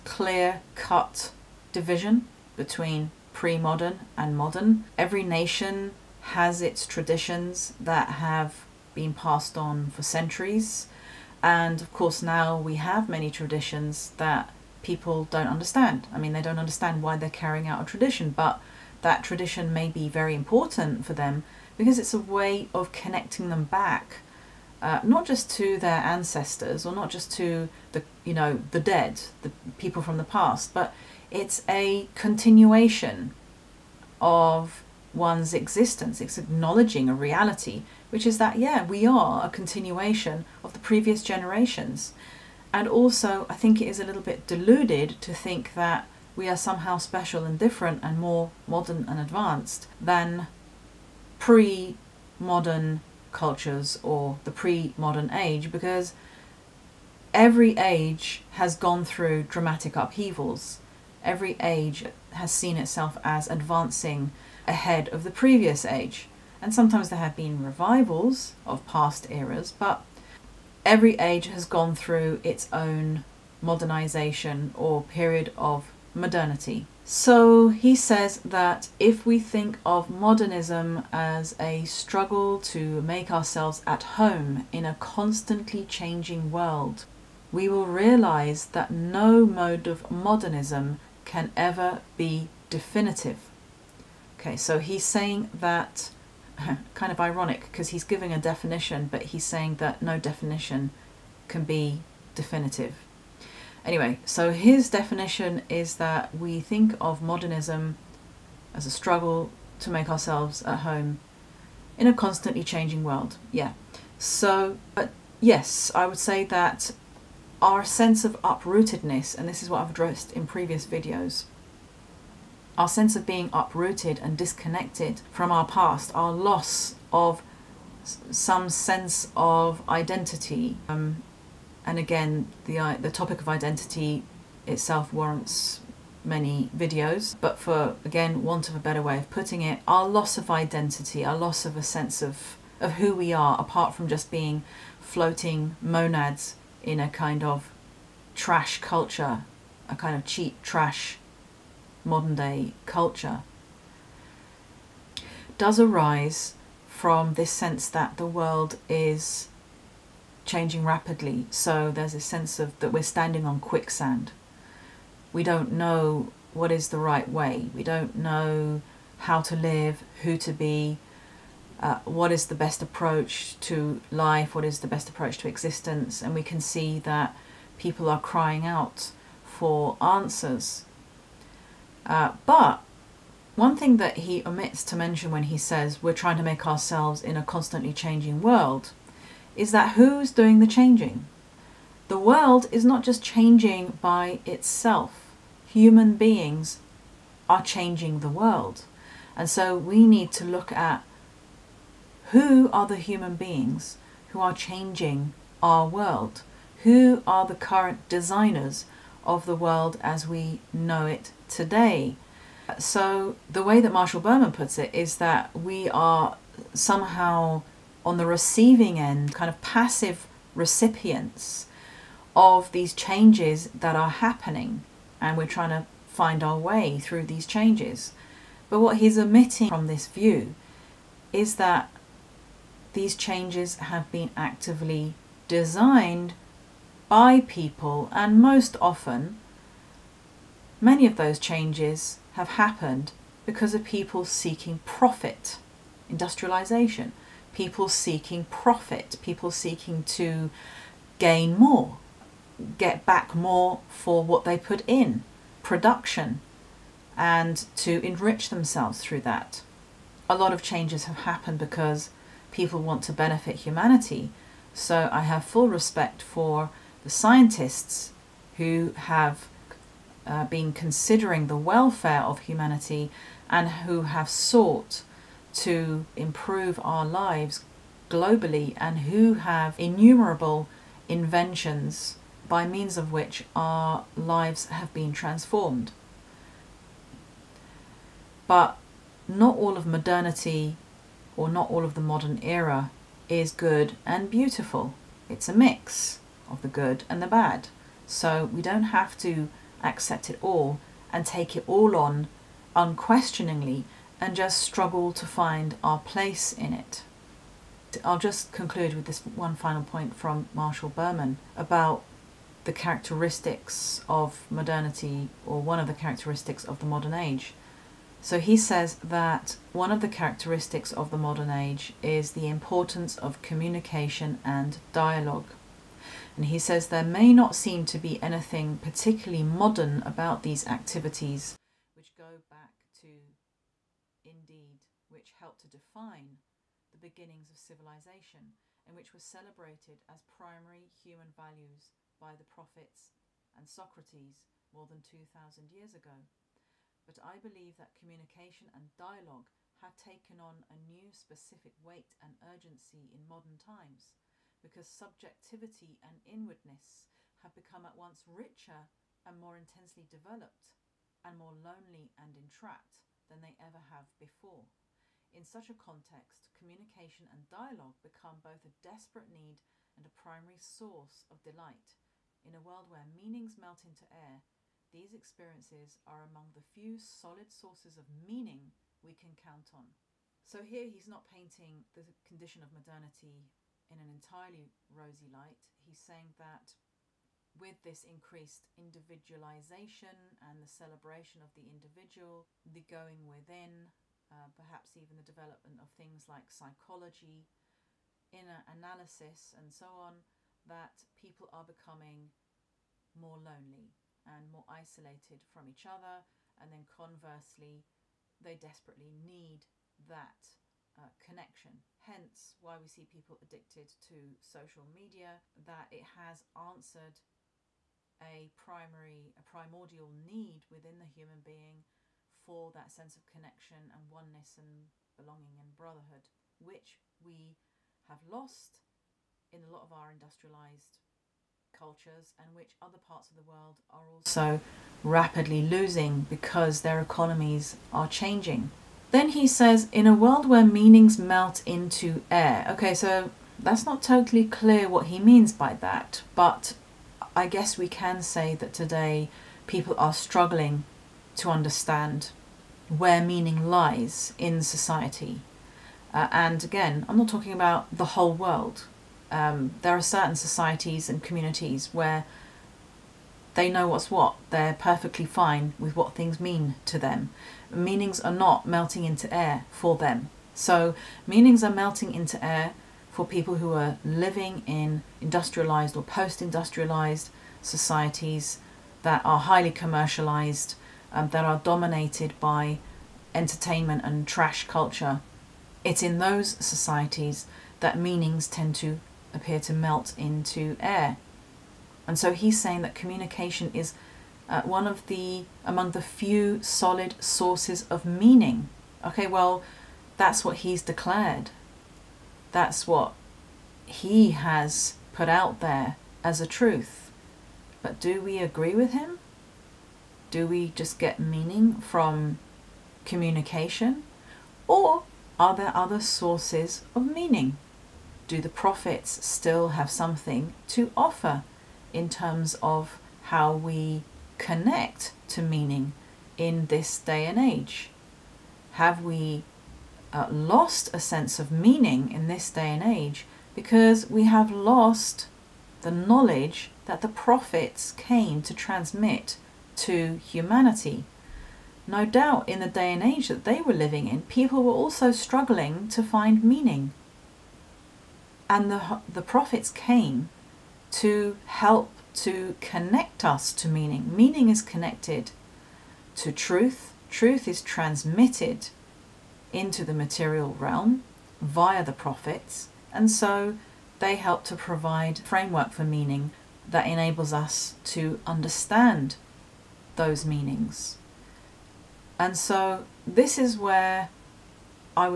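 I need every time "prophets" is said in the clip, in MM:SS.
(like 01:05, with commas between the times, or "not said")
05:42, 08:38, 08:57, 09:09, 09:21.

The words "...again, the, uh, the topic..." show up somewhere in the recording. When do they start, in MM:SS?
02:11.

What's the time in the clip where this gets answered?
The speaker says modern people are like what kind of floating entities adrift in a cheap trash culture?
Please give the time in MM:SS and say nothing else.
02:25.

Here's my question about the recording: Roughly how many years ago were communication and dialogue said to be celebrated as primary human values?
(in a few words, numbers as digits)
more than 2,000.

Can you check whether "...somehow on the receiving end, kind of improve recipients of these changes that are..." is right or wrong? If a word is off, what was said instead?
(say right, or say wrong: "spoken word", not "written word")
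wrong: "passive", not "improve".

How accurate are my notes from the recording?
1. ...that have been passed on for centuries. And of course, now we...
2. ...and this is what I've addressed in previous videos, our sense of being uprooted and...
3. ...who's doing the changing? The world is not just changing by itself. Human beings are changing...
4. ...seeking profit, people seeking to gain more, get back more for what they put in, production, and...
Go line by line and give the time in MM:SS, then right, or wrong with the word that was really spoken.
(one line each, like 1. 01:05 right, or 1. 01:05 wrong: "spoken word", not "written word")
1. 00:07 right
2. 01:59 right
3. 03:09 right
4. 04:07 right.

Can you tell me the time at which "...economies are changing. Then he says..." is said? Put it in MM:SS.
07:17.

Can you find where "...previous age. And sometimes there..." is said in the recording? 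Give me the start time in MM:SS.
01:05.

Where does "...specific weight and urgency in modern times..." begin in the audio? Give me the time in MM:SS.
05:51.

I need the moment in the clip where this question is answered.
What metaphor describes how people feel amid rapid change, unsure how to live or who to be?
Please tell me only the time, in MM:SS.
02:43.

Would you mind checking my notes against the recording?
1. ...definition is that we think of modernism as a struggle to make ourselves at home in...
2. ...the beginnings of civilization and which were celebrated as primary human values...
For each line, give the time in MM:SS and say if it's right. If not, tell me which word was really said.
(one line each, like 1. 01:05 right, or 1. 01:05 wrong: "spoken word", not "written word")
1. 01:44 right
2. 05:36 right.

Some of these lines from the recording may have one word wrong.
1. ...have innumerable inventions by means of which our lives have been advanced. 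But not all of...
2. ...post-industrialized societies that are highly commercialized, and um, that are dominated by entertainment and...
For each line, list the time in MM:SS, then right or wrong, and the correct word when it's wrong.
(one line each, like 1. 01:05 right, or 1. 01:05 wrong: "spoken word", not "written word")
1. 04:39 wrong: "transformed", not "advanced"
2. 07:56 right.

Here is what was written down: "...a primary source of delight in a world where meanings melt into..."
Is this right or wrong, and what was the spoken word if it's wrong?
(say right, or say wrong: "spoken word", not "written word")
right.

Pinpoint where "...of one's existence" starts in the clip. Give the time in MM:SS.
00:34.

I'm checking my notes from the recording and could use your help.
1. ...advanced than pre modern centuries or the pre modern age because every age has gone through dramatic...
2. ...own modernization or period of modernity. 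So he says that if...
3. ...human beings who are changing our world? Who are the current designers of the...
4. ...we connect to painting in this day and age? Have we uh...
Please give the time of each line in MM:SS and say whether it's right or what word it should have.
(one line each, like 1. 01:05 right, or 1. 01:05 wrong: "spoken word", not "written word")
1. 00:49 wrong: "cultures", not "centuries"
2. 01:12 right
3. 03:22 right
4. 08:43 wrong: "meaning", not "painting".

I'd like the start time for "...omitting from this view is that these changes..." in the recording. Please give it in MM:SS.
03:49.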